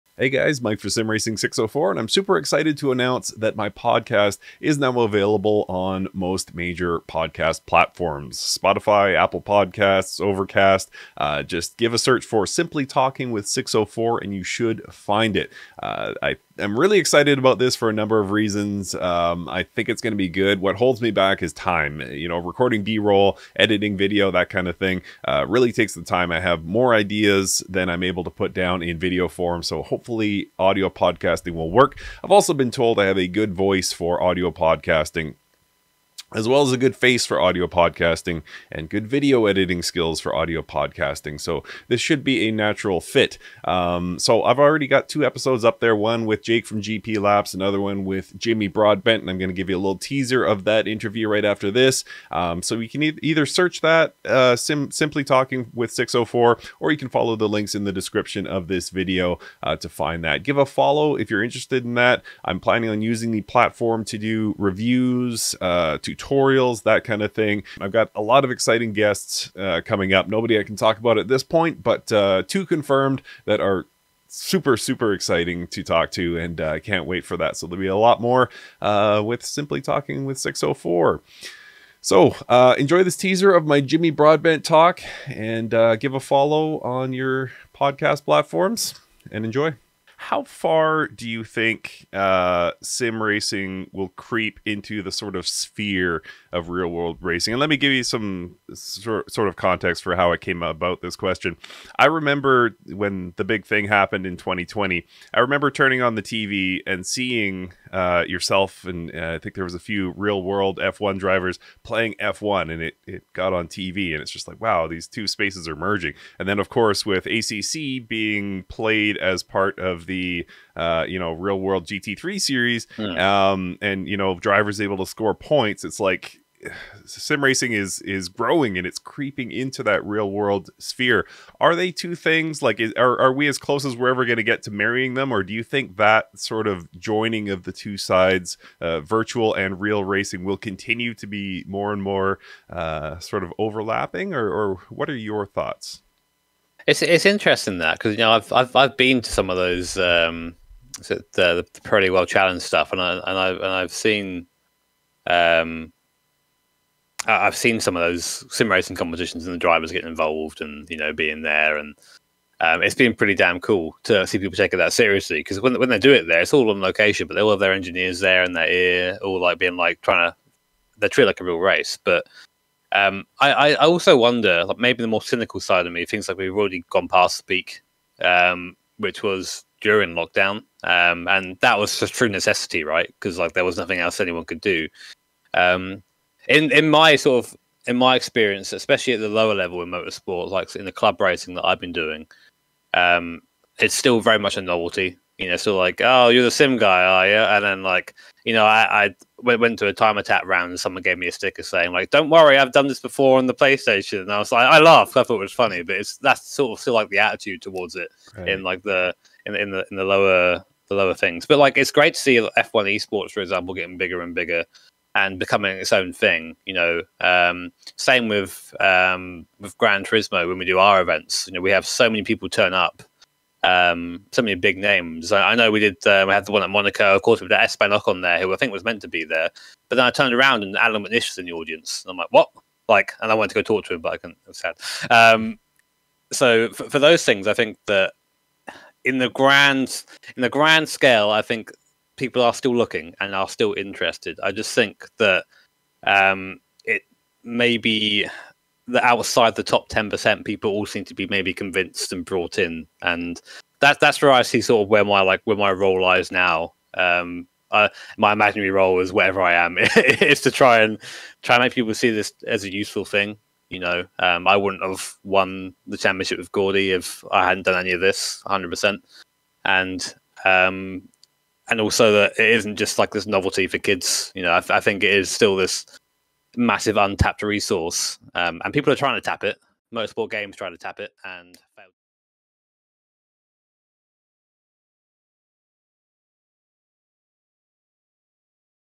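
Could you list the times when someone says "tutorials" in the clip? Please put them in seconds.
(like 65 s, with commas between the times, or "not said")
66 s.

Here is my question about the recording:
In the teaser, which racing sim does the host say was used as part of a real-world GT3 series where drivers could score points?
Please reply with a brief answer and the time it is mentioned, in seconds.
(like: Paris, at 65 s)
ACC, at 117 s.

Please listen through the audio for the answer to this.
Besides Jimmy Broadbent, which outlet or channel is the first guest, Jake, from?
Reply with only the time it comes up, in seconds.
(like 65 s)
46 s.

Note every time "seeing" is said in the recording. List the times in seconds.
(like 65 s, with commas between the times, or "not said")
107 s.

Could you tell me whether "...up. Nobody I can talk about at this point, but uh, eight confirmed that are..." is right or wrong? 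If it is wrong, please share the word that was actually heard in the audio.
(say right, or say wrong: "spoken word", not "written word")
wrong: "two", not "eight".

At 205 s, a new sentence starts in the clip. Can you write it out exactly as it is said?
I thought it was funny, but it's that's sort of still like the attitude towards it right.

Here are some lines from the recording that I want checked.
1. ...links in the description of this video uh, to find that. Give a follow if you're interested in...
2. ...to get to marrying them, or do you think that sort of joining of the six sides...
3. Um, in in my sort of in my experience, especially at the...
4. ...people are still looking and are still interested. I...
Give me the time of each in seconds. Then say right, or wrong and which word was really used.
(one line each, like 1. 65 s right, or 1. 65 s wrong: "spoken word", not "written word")
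1. 57 s right
2. 134 s wrong: "two", not "six"
3. 185 s right
4. 242 s right.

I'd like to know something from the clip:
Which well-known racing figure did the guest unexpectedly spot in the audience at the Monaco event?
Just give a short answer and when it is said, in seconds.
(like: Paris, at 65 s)
Allan McNish, at 230 s.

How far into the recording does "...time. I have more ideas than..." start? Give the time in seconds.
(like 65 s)
26 s.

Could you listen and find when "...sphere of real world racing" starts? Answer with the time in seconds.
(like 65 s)
95 s.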